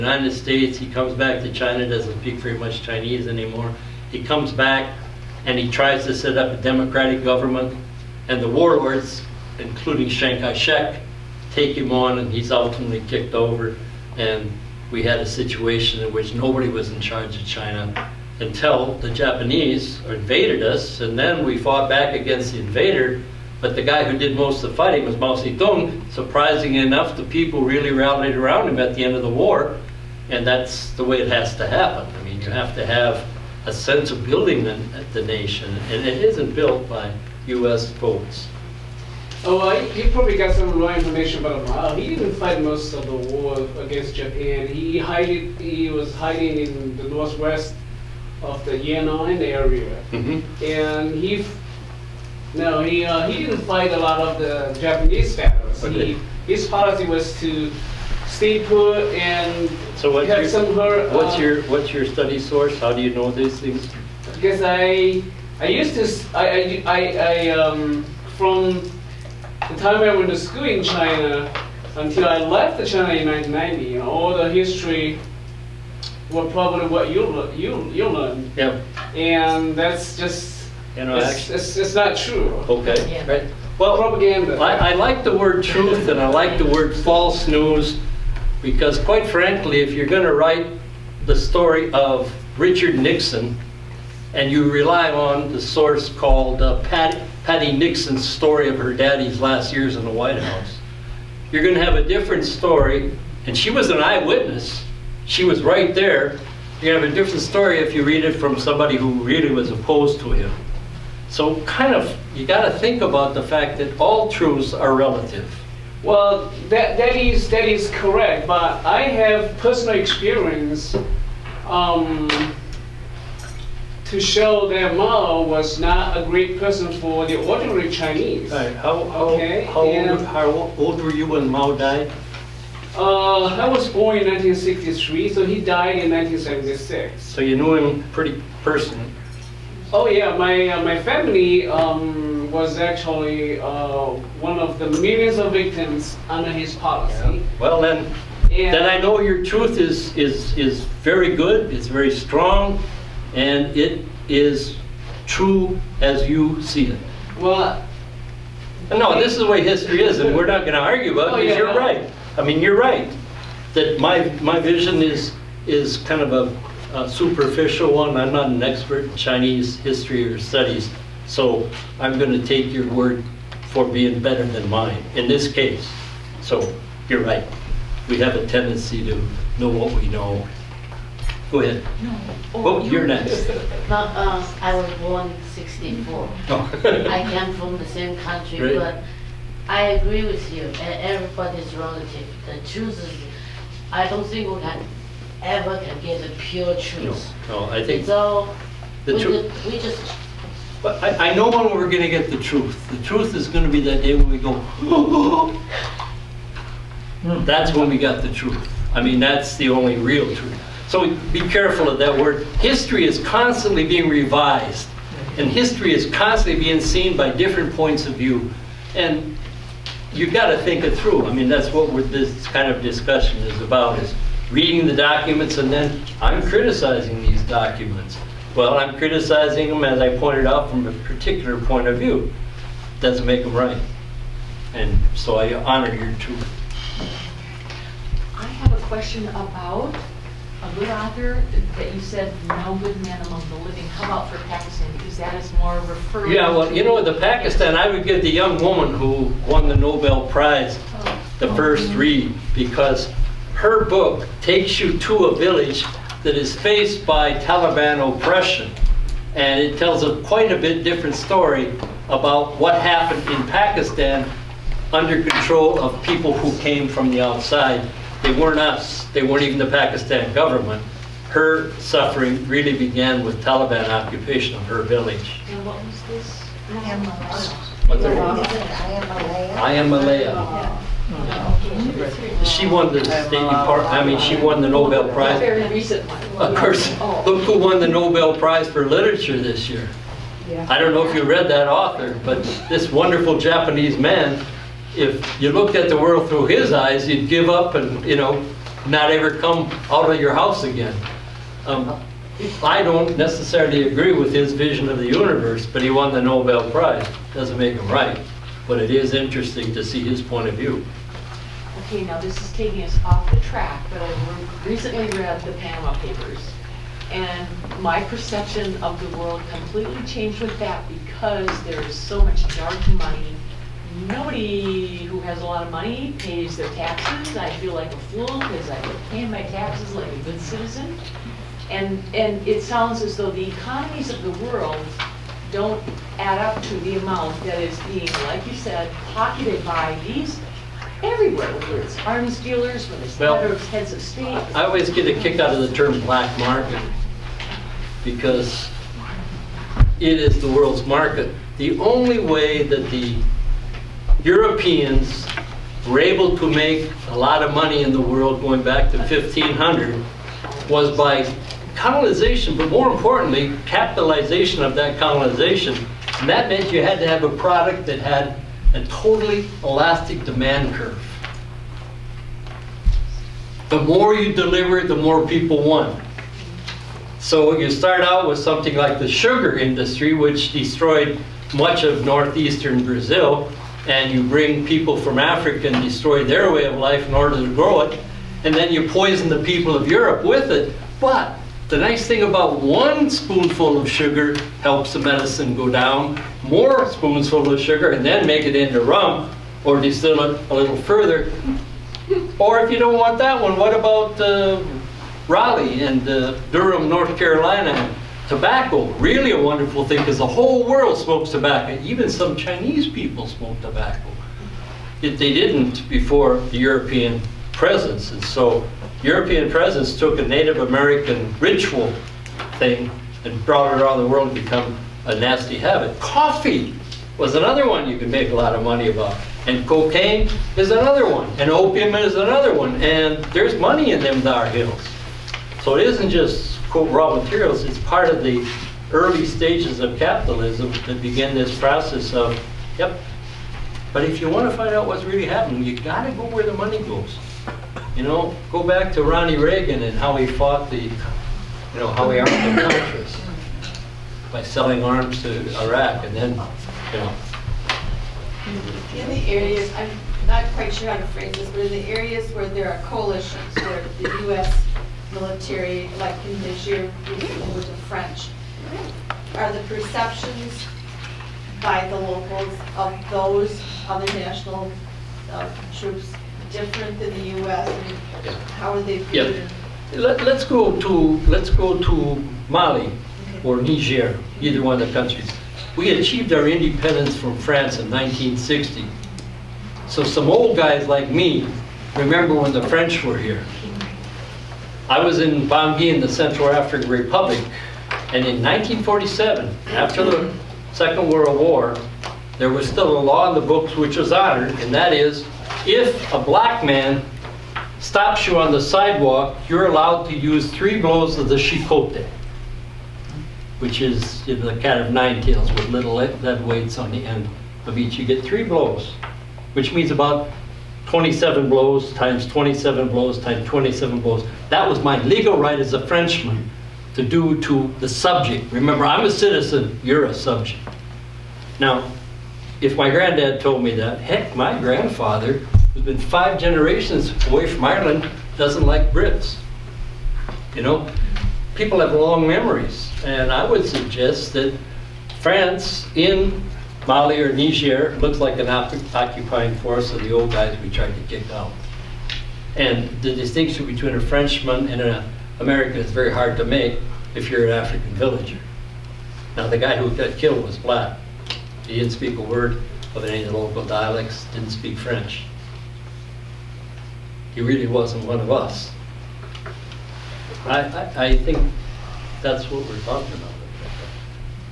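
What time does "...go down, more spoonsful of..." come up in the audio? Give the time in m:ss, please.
6:35.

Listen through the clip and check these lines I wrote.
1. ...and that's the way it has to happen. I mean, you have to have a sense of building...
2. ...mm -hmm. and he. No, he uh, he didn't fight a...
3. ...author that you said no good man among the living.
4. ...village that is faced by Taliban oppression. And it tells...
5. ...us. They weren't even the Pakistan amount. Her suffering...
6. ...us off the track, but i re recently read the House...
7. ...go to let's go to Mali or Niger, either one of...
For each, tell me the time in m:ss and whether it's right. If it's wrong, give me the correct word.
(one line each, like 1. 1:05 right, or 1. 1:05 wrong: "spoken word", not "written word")
1. 0:30 right
2. 0:50 right
3. 4:00 right
4. 4:15 right
5. 4:28 wrong: "government", not "amount"
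6. 5:12 wrong: "Panama", not "House"
7. 8:00 right.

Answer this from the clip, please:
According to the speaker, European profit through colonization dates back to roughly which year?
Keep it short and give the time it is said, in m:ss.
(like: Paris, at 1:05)
1500, at 5:58.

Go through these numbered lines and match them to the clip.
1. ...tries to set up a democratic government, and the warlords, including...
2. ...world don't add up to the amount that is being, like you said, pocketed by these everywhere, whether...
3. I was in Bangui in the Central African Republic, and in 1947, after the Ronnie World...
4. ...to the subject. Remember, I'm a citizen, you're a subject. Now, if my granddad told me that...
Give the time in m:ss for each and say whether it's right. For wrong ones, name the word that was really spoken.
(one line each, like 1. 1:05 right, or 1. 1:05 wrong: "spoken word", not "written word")
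1. 0:05 right
2. 5:34 right
3. 8:14 wrong: "Second", not "Ronnie"
4. 8:47 right.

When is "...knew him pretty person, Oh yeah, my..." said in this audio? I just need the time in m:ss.
2:17.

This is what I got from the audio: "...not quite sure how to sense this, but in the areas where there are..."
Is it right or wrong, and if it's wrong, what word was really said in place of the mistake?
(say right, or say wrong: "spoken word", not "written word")
wrong: "phrase", not "sense".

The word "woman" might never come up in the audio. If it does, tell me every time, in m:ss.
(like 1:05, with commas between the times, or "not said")
4:08.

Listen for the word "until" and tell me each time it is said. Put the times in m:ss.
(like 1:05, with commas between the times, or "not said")
0:18, 1:11.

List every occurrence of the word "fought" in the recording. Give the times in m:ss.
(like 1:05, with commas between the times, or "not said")
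0:21, 7:30.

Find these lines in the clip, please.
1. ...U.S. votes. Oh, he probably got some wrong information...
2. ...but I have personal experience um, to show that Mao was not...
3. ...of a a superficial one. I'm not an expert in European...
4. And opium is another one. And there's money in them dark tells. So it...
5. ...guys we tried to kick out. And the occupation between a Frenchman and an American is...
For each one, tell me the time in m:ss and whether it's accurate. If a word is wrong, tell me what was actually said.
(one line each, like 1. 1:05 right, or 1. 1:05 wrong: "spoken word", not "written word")
1. 0:37 right
2. 1:58 right
3. 2:46 wrong: "Chinese", not "European"
4. 7:11 wrong: "hills", not "tells"
5. 9:10 wrong: "distinction", not "occupation".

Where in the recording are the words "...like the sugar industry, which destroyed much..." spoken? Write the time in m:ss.
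6:18.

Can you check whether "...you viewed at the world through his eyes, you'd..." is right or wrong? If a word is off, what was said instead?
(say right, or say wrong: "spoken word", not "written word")
wrong: "looked", not "viewed".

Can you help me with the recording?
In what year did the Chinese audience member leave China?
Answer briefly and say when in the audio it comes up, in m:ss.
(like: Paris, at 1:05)
1990, at 1:13.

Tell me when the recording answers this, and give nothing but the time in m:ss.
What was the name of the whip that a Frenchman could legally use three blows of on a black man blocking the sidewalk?
8:31.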